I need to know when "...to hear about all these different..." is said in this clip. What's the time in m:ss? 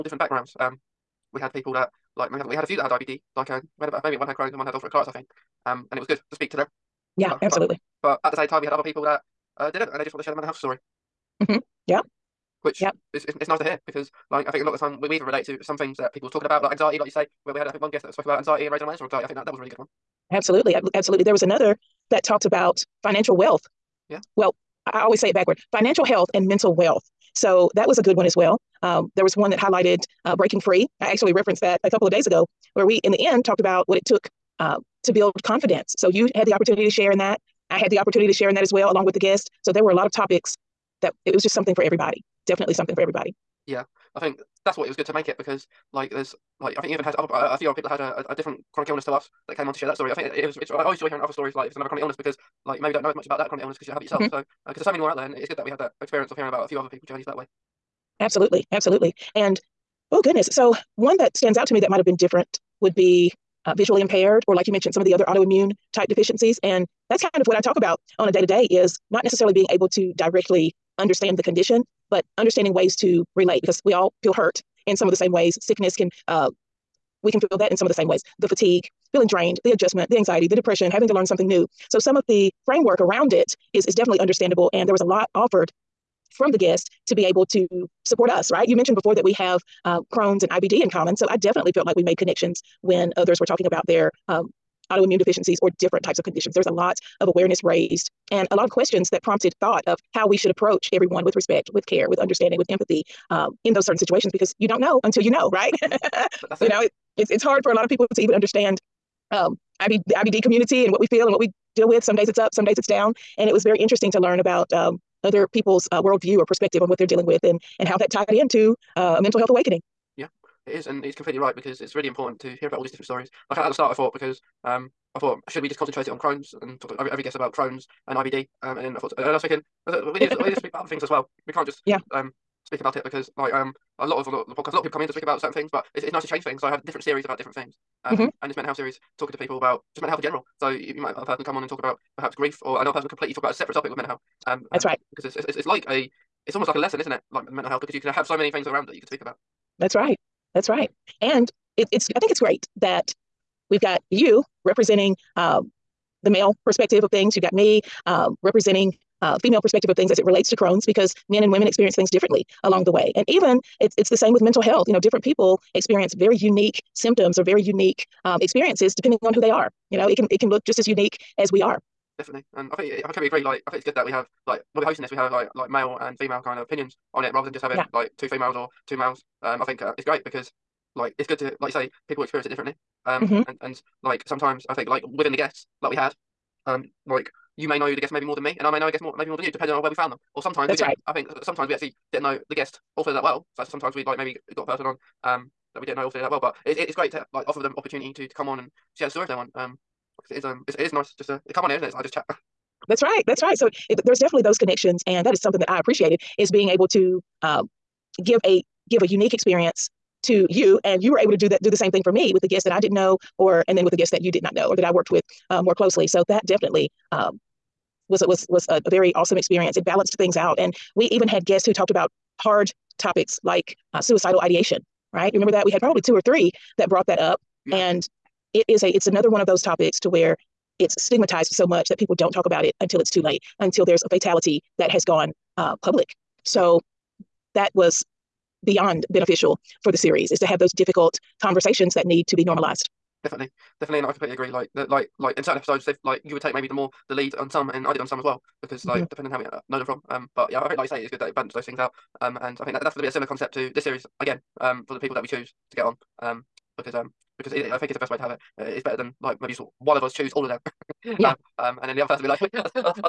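2:02.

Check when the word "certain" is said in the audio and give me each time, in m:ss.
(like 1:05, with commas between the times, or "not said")
1:43, 2:15, 4:05.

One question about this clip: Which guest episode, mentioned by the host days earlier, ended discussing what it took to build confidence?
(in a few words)
Breaking Free.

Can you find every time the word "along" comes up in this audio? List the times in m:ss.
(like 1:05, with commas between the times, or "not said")
0:38, 2:42.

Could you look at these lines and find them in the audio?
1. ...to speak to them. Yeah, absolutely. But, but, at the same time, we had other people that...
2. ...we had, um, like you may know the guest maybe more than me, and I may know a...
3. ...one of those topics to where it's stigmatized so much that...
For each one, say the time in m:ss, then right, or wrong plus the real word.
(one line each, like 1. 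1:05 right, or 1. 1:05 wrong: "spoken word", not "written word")
1. 0:06 right
2. 3:05 right
3. 3:49 right.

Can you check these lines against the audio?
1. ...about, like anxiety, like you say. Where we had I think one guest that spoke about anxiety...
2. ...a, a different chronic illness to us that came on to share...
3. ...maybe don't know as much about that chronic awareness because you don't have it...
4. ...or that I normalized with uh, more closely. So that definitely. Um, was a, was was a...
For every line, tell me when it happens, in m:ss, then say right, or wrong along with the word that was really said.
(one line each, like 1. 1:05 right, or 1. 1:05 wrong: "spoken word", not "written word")
1. 0:16 right
2. 0:48 right
3. 0:52 wrong: "illness", not "awareness"
4. 3:34 wrong: "worked", not "normalized".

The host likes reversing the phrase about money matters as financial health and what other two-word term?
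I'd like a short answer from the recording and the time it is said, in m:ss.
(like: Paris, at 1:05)
mental wealth, at 0:26.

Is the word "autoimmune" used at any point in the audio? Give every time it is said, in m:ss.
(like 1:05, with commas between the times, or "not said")
1:05, 1:34.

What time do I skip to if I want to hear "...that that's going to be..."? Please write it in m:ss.
4:12.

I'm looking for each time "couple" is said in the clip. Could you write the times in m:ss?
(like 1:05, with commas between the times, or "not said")
0:31.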